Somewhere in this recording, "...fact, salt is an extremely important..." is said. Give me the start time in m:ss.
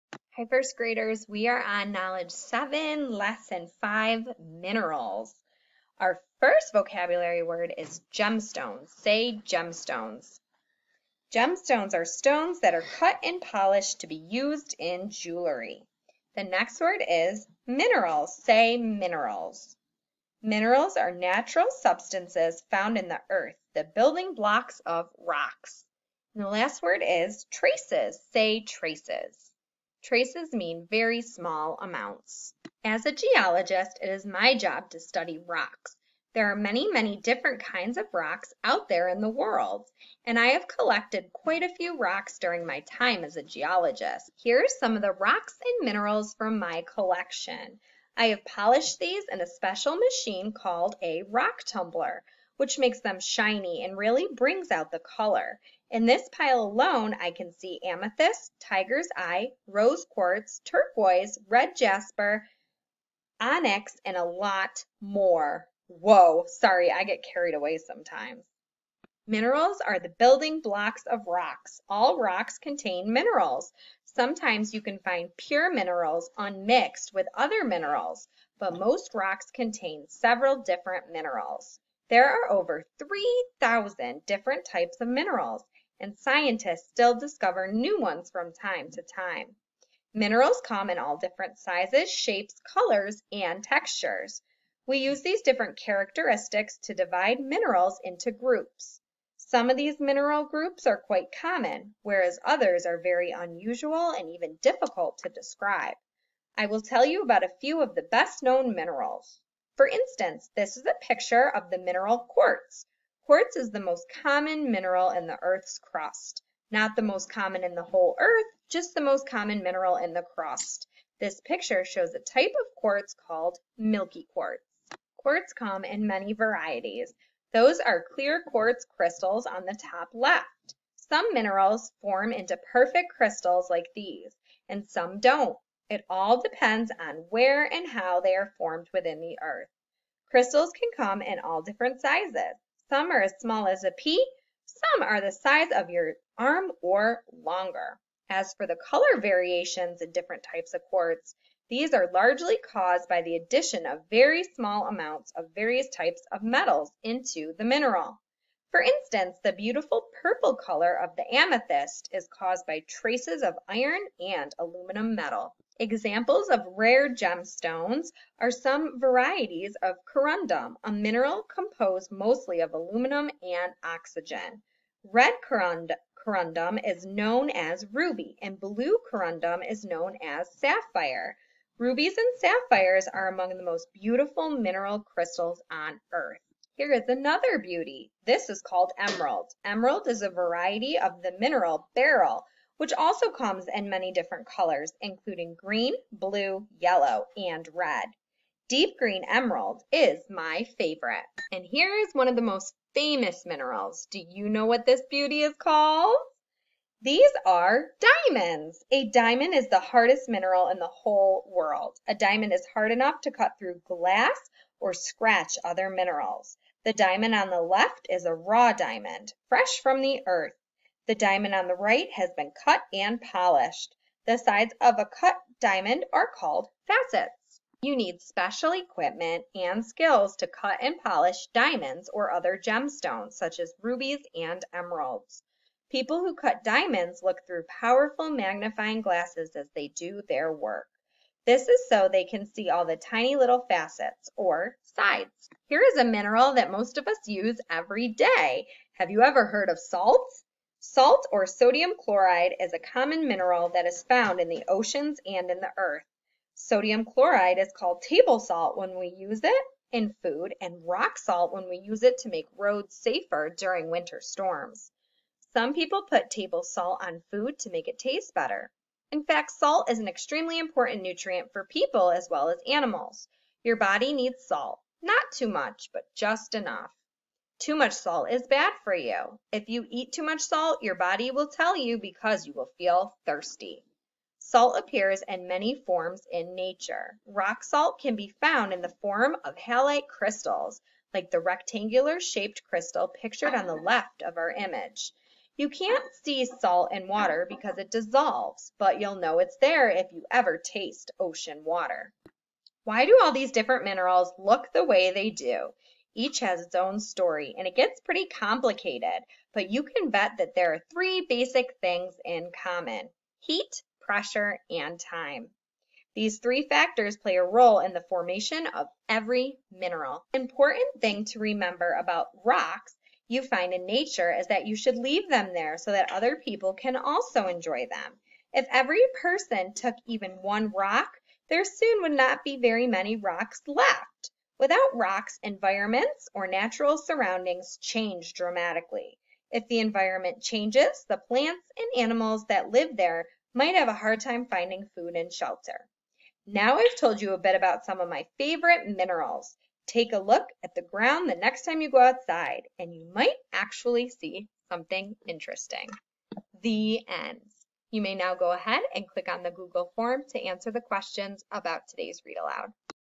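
4:29.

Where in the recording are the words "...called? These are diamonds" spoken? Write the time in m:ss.
3:25.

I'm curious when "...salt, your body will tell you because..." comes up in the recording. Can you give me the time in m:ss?
4:40.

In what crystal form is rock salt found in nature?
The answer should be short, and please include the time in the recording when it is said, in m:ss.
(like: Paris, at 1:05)
halite crystals, at 4:49.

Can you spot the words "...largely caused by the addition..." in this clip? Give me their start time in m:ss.
2:32.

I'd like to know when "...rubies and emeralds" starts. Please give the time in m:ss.
3:53.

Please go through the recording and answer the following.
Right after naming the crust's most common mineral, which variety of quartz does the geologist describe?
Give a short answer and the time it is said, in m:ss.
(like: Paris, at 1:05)
milky quartz, at 2:03.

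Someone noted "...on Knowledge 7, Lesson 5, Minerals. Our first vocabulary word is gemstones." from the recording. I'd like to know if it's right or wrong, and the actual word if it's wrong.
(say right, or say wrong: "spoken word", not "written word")
right.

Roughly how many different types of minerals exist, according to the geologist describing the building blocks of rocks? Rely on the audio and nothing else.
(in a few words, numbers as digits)
over 3,000.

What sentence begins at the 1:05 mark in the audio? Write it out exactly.
Whoa, sorry, I get carried away sometimes.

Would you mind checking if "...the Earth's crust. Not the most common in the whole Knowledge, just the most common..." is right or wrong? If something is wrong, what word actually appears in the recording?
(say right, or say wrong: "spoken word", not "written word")
wrong: "Earth", not "Knowledge".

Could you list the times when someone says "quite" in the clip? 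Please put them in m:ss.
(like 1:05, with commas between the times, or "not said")
0:41, 1:41.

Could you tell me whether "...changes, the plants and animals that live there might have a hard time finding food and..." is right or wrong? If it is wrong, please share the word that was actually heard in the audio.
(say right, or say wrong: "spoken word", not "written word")
right.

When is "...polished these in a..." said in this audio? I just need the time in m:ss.
0:48.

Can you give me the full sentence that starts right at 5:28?
If every person took even one rock, there soon would not be very many rocks left.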